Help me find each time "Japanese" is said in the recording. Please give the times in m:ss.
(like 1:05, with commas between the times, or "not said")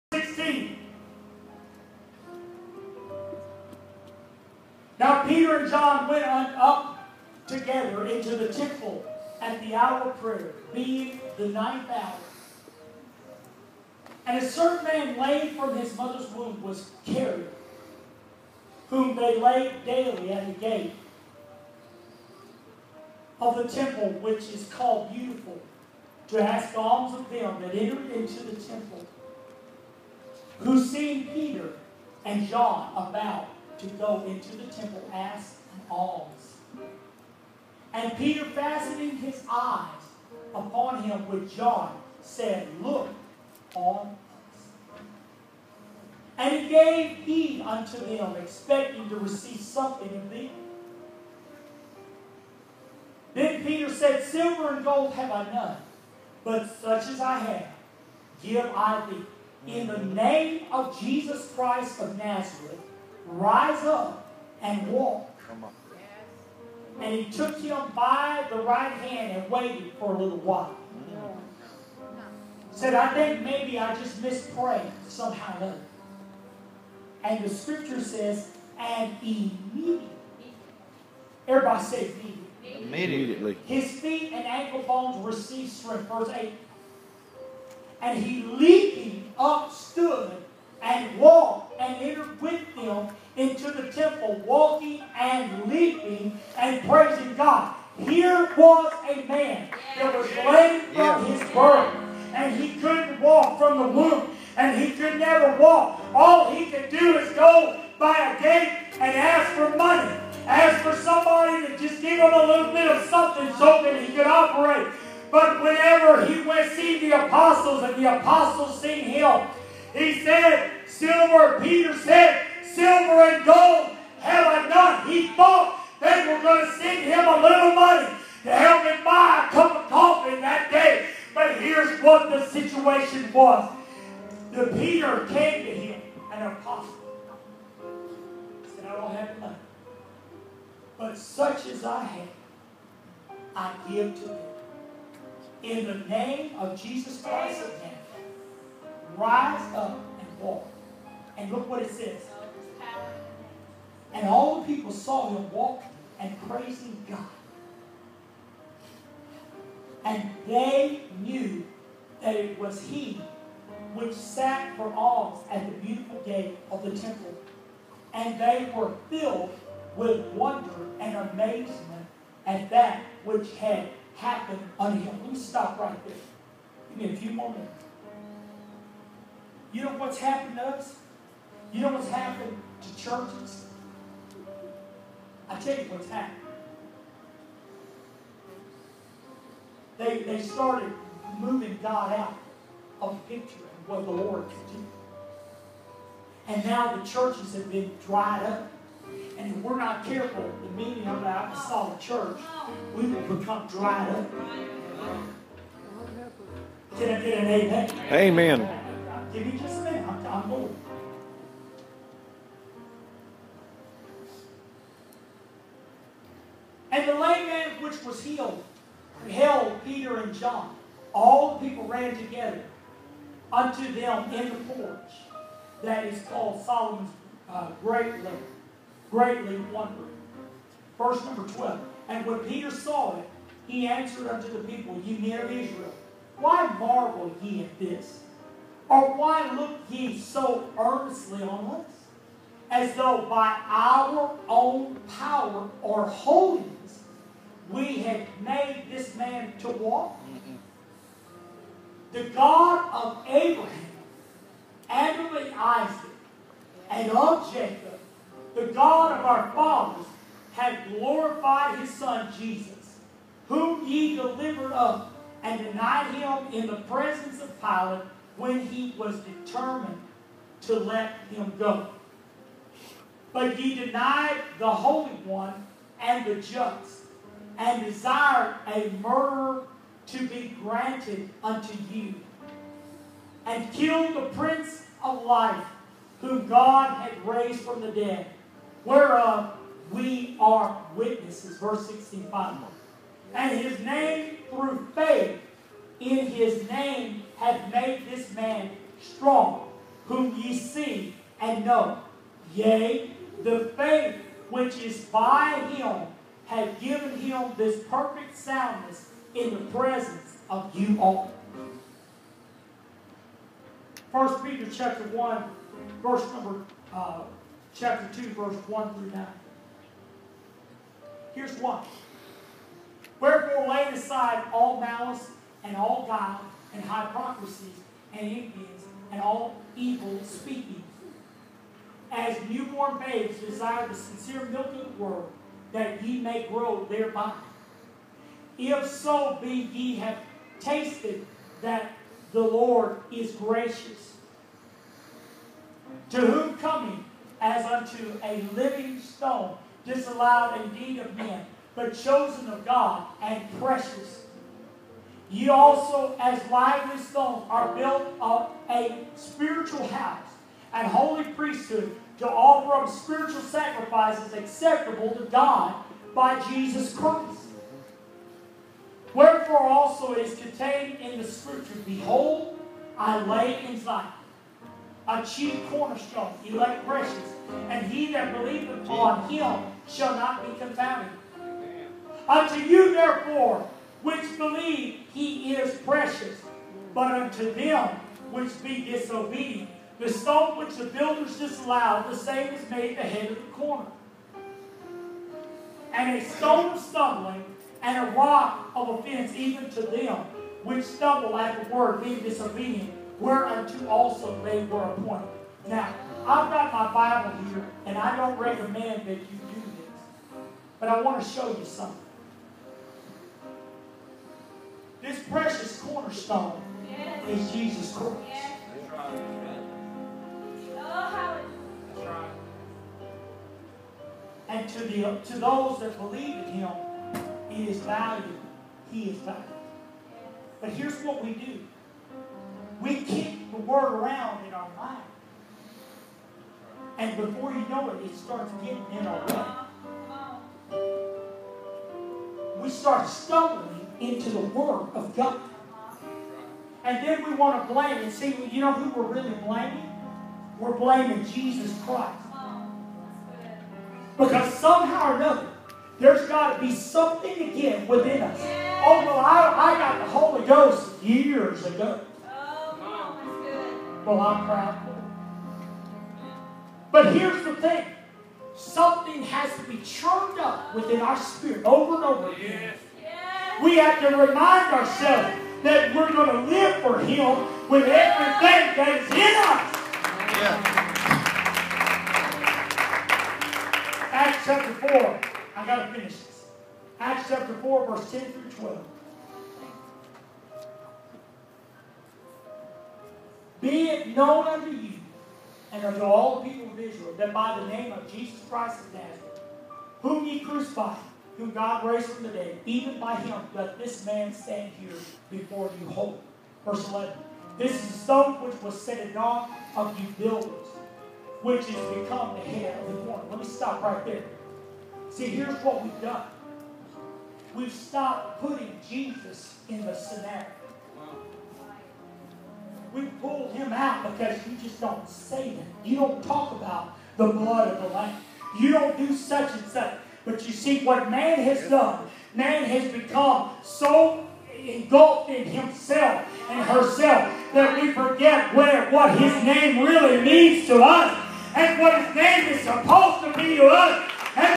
not said.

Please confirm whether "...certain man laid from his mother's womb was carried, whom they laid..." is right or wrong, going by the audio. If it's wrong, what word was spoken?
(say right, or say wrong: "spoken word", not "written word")
right.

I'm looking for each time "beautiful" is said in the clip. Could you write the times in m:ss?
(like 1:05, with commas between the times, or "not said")
0:25, 2:45.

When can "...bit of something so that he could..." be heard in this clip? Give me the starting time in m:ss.
1:52.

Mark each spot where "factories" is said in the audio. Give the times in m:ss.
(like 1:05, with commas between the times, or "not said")
not said.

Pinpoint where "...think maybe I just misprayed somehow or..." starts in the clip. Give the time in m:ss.
1:13.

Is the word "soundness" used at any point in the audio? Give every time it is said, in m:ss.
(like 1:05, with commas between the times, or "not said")
5:08.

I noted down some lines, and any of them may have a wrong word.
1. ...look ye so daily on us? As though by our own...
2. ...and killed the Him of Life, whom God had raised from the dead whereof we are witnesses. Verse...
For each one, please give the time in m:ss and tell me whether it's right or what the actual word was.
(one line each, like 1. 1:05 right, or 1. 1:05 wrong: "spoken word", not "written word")
1. 3:59 wrong: "earnestly", not "daily"
2. 4:43 wrong: "Prince", not "Him".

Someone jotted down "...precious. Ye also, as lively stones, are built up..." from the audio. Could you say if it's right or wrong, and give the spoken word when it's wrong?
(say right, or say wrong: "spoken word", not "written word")
right.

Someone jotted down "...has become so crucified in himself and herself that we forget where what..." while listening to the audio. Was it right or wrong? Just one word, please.
wrong.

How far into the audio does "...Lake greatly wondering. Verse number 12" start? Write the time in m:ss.
3:48.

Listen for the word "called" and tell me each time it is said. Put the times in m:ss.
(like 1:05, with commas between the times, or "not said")
0:24, 3:46.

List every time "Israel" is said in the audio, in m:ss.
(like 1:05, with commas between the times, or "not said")
3:55, 8:16.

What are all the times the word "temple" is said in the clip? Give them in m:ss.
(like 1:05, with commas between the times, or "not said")
0:08, 0:23, 0:28, 0:34, 1:33, 2:46.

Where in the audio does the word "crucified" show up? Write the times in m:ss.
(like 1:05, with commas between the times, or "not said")
8:20.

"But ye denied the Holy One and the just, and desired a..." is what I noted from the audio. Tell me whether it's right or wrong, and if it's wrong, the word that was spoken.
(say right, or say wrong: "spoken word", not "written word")
right.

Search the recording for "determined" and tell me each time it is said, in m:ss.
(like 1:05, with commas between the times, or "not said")
4:29.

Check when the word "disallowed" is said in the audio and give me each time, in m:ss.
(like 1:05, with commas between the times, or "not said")
5:49, 6:31.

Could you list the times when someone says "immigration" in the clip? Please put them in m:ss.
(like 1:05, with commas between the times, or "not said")
not said.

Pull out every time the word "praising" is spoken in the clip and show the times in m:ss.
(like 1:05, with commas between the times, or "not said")
1:36, 2:36.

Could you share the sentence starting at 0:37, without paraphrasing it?
And Peter, fastening his eyes upon him with John, said, Look on us.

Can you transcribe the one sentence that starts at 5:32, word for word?
As newborn babes desire the sincere milk of the word, that ye may grow thereby.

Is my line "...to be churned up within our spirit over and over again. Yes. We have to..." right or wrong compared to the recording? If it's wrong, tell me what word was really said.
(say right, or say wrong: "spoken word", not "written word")
right.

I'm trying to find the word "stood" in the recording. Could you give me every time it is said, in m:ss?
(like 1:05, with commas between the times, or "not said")
1:29.